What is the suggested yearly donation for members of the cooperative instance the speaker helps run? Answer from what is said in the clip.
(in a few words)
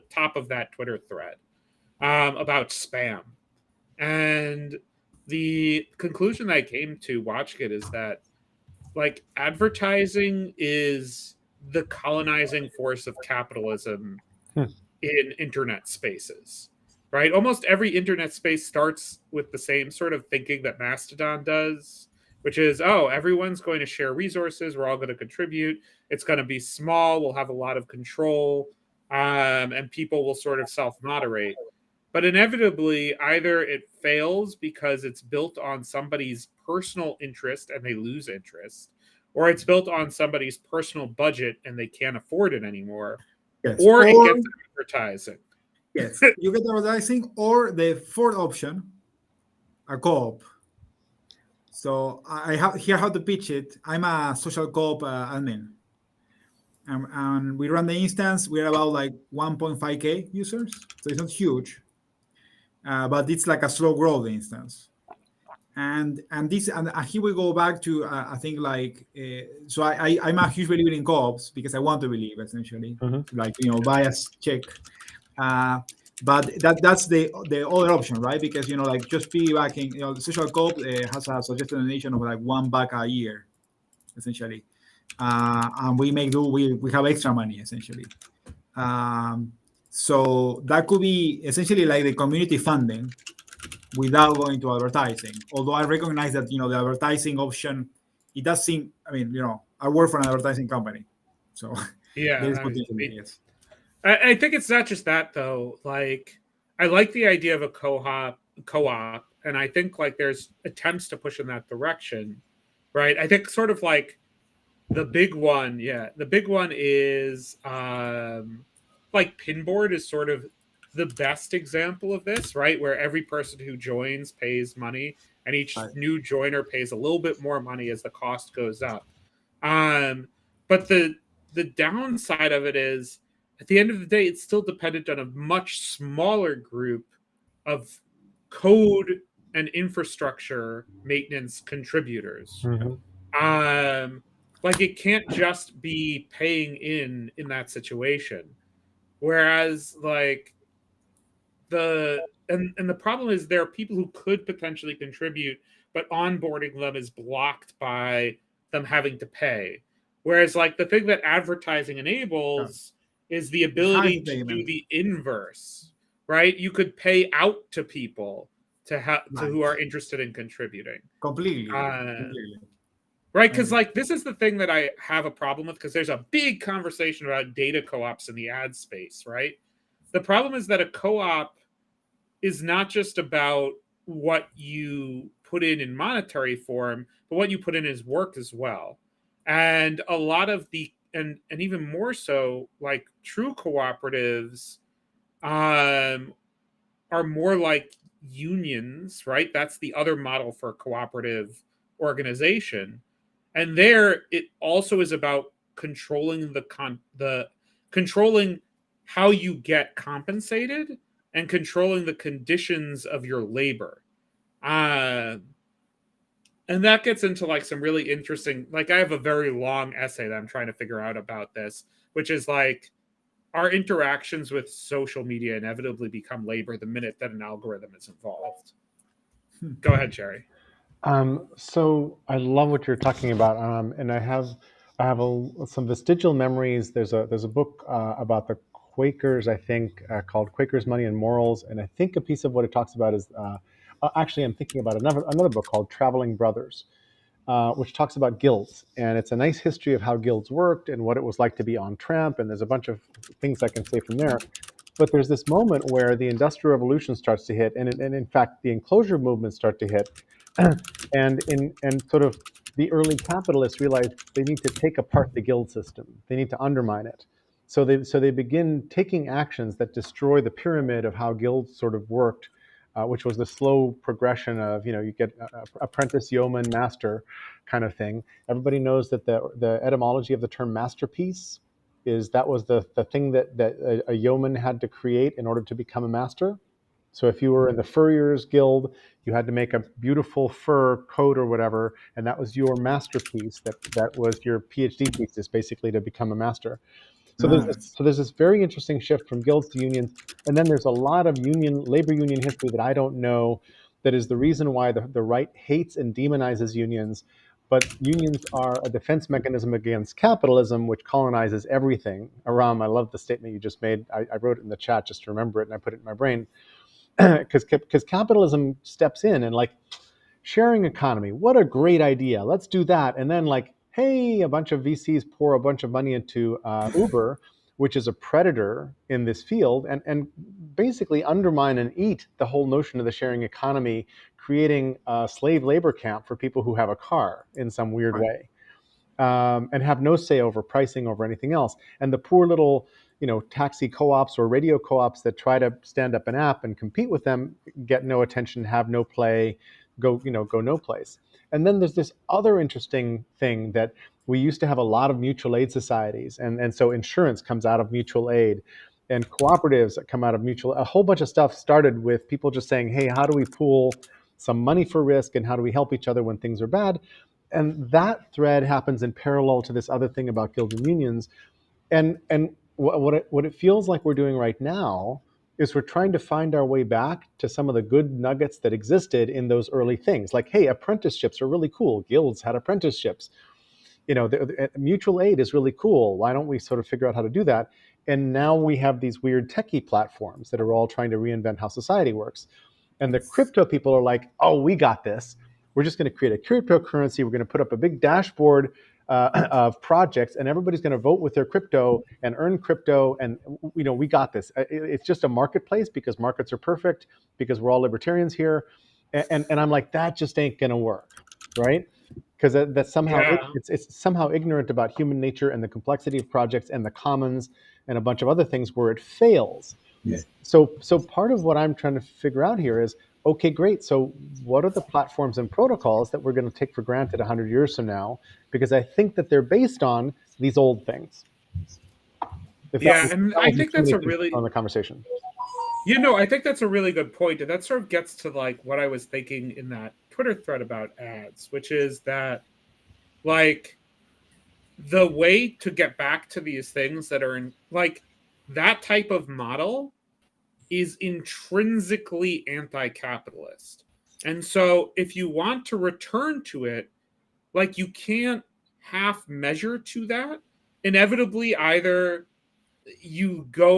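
one buck a year.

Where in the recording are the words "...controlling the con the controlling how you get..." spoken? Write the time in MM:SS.
03:25.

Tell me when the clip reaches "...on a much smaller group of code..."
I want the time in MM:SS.
02:15.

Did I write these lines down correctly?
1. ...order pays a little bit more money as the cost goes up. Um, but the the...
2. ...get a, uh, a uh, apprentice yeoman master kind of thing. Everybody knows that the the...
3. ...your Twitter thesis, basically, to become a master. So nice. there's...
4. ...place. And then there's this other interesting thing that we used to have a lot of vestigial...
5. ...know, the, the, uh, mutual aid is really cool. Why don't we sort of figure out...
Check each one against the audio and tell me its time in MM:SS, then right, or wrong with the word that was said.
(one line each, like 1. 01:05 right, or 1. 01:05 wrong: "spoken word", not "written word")
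1. 02:06 wrong: "joiner", not "order"
2. 04:35 right
3. 04:54 wrong: "PhD", not "Twitter"
4. 05:50 wrong: "mutual", not "vestigial"
5. 06:24 right.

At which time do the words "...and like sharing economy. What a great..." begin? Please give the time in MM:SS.
05:19.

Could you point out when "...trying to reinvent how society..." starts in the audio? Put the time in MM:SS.
06:30.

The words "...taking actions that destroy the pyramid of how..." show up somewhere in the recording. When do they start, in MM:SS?
04:28.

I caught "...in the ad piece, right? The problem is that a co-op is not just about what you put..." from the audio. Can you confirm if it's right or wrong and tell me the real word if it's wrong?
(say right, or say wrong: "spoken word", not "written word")
wrong: "space", not "piece".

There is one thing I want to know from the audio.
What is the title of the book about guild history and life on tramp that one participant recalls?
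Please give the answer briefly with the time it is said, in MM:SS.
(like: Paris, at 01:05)
Traveling Brothers, at 04:05.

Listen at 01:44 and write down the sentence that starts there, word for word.
I, I think it's not just that though.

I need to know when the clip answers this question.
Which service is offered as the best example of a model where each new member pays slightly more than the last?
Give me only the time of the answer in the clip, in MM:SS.
01:59.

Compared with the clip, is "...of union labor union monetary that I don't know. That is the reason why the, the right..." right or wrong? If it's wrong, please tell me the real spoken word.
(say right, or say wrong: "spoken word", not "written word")
wrong: "history", not "monetary".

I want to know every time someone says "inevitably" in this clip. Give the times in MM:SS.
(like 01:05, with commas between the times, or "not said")
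00:32, 03:45, 07:40.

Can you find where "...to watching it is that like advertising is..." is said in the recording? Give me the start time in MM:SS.
00:06.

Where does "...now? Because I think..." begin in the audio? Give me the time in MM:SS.
07:07.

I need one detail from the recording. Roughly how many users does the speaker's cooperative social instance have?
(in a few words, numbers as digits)
1.5k.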